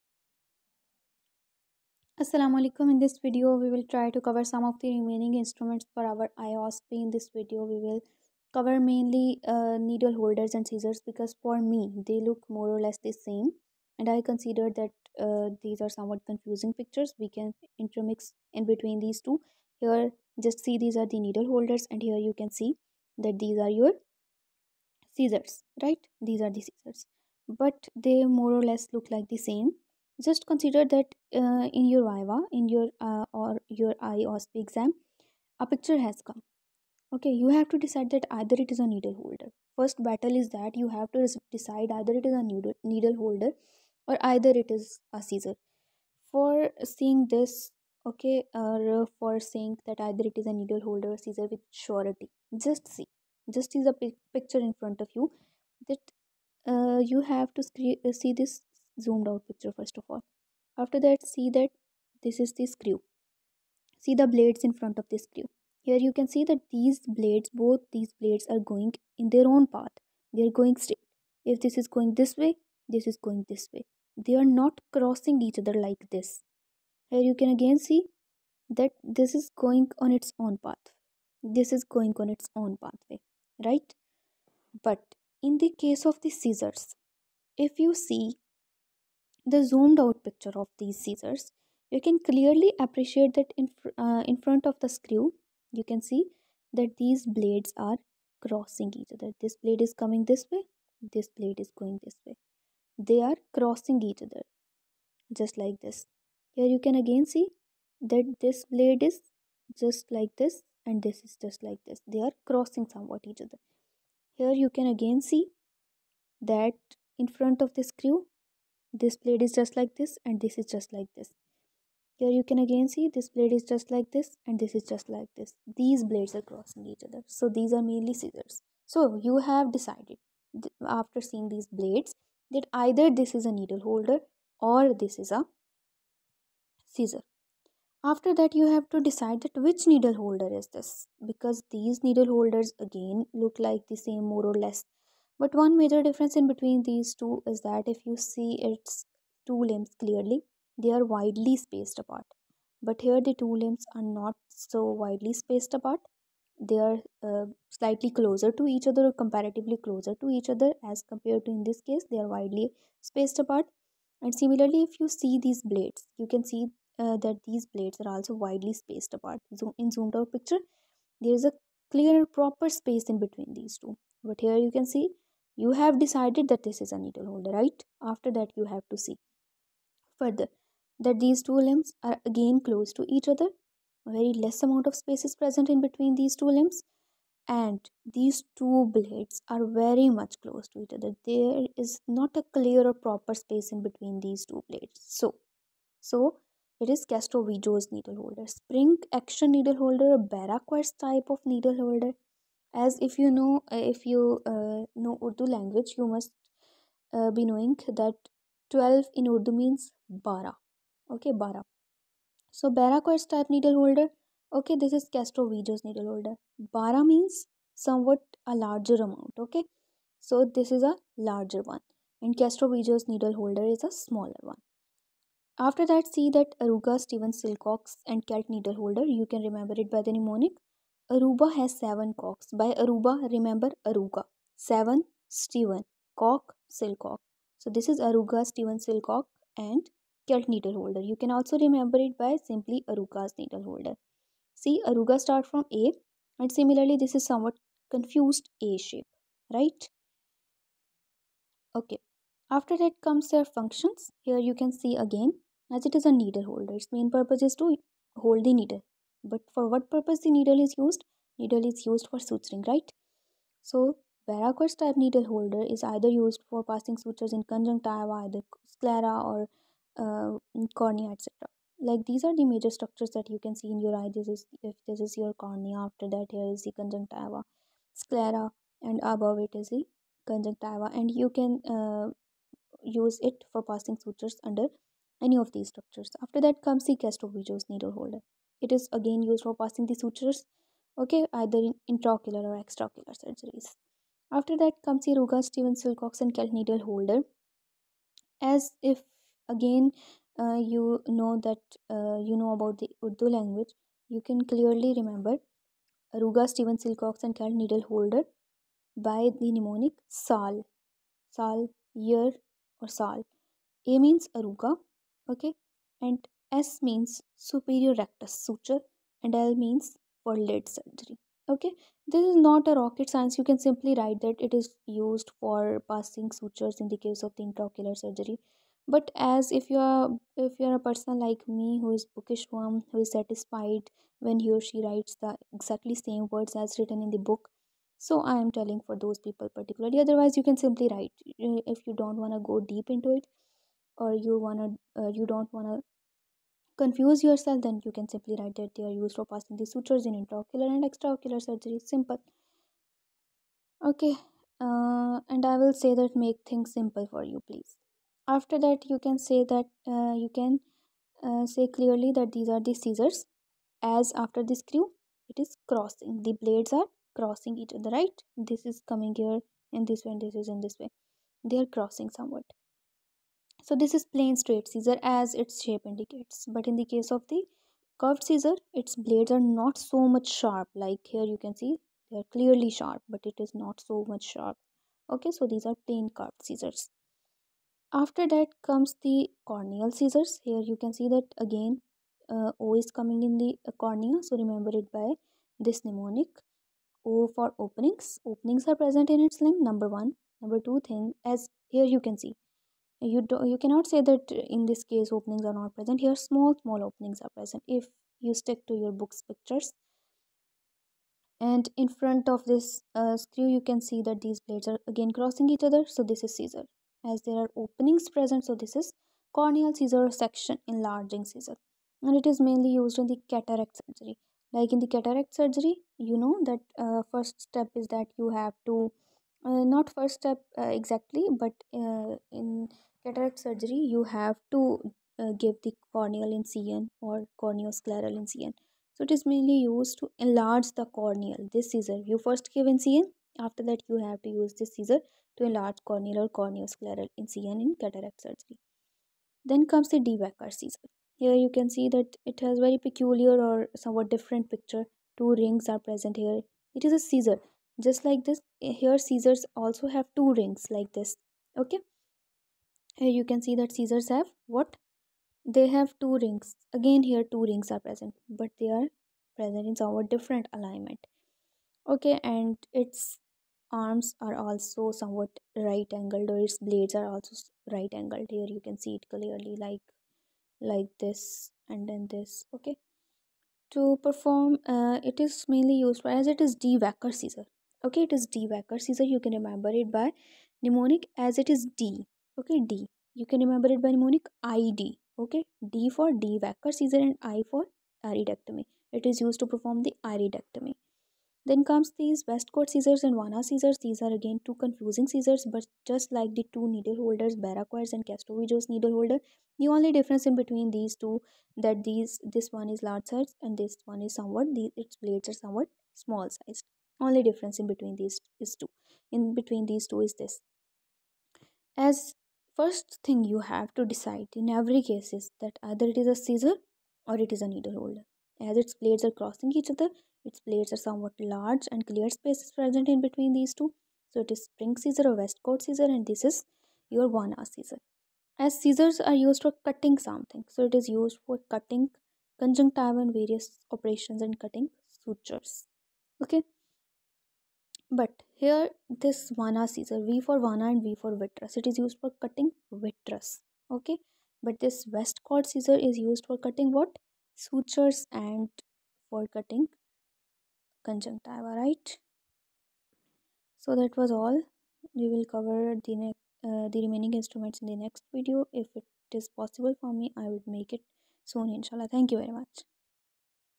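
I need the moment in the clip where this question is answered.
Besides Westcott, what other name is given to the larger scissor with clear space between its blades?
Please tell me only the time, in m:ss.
8:54.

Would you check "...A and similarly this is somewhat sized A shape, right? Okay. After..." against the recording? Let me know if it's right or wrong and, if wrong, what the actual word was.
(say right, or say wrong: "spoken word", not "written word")
wrong: "confused", not "sized".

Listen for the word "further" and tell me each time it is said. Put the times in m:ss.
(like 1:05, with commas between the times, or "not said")
3:00.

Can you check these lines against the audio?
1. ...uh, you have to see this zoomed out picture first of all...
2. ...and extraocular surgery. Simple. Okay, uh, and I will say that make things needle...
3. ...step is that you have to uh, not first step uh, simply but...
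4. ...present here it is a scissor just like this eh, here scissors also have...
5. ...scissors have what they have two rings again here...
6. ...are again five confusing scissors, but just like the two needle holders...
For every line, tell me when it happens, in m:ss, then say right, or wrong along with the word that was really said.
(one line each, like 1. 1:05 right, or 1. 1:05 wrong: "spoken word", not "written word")
1. 0:56 right
2. 5:50 wrong: "simple", not "needle"
3. 7:07 wrong: "exactly", not "simply"
4. 7:35 right
5. 7:43 right
6. 8:24 wrong: "two", not "five".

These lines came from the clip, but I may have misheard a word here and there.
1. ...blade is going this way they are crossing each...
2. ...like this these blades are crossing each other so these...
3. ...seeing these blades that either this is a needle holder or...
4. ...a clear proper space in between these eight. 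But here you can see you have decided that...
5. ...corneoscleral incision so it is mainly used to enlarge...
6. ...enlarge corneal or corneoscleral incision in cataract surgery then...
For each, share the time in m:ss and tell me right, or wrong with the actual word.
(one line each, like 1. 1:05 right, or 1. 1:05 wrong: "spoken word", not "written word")
1. 1:41 right
2. 2:05 right
3. 2:11 right
4. 2:51 wrong: "two", not "eight"
5. 7:17 right
6. 7:25 right.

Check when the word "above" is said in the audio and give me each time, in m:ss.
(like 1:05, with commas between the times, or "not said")
4:39.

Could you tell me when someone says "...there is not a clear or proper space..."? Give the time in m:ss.
3:11.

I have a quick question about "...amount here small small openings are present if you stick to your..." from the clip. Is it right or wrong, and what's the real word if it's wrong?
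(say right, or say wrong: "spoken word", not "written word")
wrong: "present", not "amount".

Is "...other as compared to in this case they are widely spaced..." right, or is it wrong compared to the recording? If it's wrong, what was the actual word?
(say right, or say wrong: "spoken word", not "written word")
right.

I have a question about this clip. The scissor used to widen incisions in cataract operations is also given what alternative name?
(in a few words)
section enlarging scissor.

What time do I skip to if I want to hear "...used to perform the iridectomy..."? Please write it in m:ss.
8:19.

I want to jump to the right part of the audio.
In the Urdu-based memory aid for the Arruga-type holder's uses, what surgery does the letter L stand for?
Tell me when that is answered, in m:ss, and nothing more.
5:20.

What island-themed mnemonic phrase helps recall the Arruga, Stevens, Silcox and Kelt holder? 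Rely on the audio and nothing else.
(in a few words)
Aruba has seven cocks.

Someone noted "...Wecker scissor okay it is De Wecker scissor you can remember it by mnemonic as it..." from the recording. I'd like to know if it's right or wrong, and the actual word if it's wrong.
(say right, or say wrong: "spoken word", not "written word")
right.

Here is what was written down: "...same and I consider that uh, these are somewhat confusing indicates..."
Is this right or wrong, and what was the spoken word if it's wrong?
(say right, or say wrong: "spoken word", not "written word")
wrong: "pictures", not "indicates".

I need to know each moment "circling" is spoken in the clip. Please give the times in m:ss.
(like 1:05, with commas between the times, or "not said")
not said.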